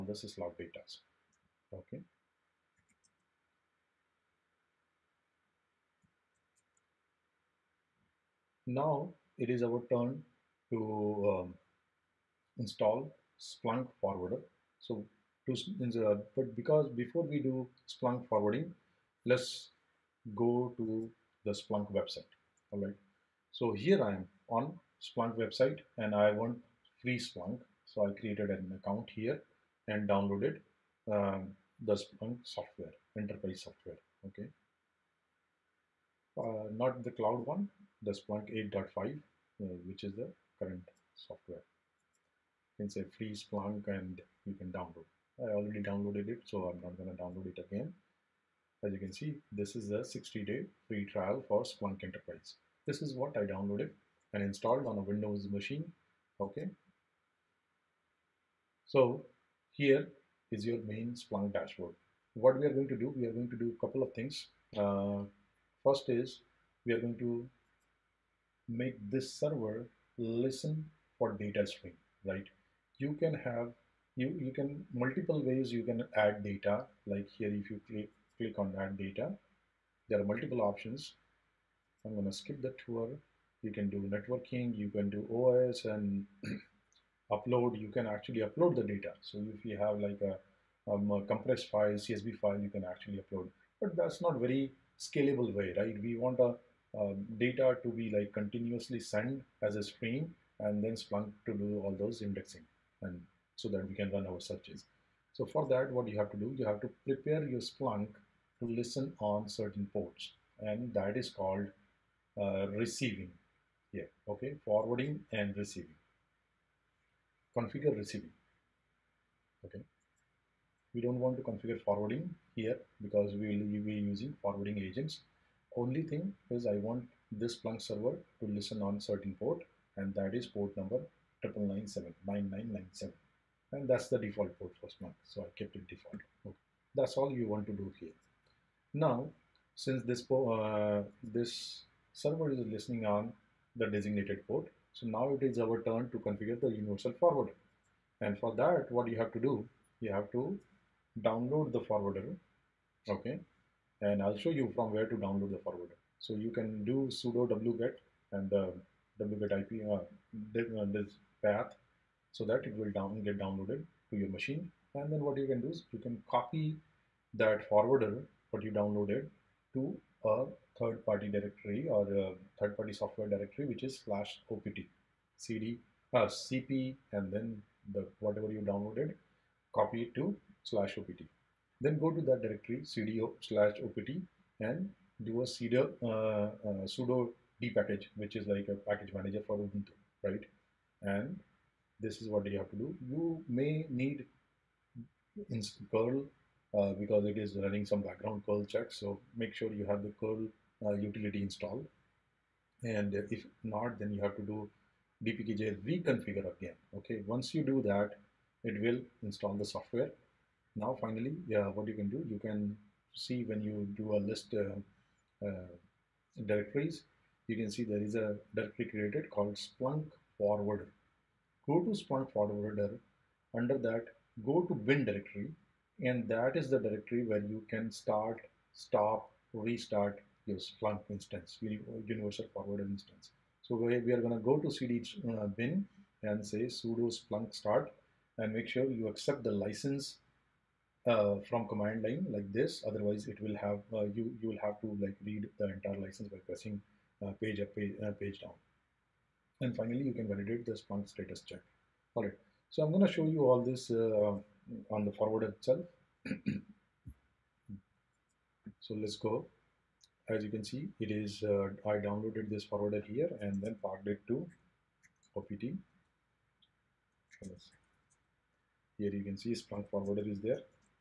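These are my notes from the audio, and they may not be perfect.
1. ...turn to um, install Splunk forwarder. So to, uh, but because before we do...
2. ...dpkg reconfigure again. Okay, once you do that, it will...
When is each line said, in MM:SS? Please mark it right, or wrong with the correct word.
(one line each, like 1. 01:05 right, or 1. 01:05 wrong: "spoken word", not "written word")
1. 00:09 right
2. 03:25 right.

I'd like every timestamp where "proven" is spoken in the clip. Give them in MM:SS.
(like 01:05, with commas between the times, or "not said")
not said.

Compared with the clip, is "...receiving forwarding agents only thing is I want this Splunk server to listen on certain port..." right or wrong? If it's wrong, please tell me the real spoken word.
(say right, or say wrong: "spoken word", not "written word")
wrong: "using", not "receiving".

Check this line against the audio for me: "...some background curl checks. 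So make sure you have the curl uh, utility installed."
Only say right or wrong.
right.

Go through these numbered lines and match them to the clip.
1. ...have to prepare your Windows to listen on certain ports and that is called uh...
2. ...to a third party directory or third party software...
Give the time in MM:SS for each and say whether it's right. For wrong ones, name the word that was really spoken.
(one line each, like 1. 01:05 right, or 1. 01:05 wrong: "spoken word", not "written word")
1. 01:46 wrong: "Splunk", not "Windows"
2. 02:49 right.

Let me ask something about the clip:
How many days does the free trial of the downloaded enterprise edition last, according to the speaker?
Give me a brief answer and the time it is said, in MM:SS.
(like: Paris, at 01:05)
60, at 00:50.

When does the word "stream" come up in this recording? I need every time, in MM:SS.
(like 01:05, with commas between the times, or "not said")
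01:11, 01:39.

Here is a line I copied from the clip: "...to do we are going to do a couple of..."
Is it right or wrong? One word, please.
right.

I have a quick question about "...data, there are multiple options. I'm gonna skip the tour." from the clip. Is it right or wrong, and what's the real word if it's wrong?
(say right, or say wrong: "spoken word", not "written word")
right.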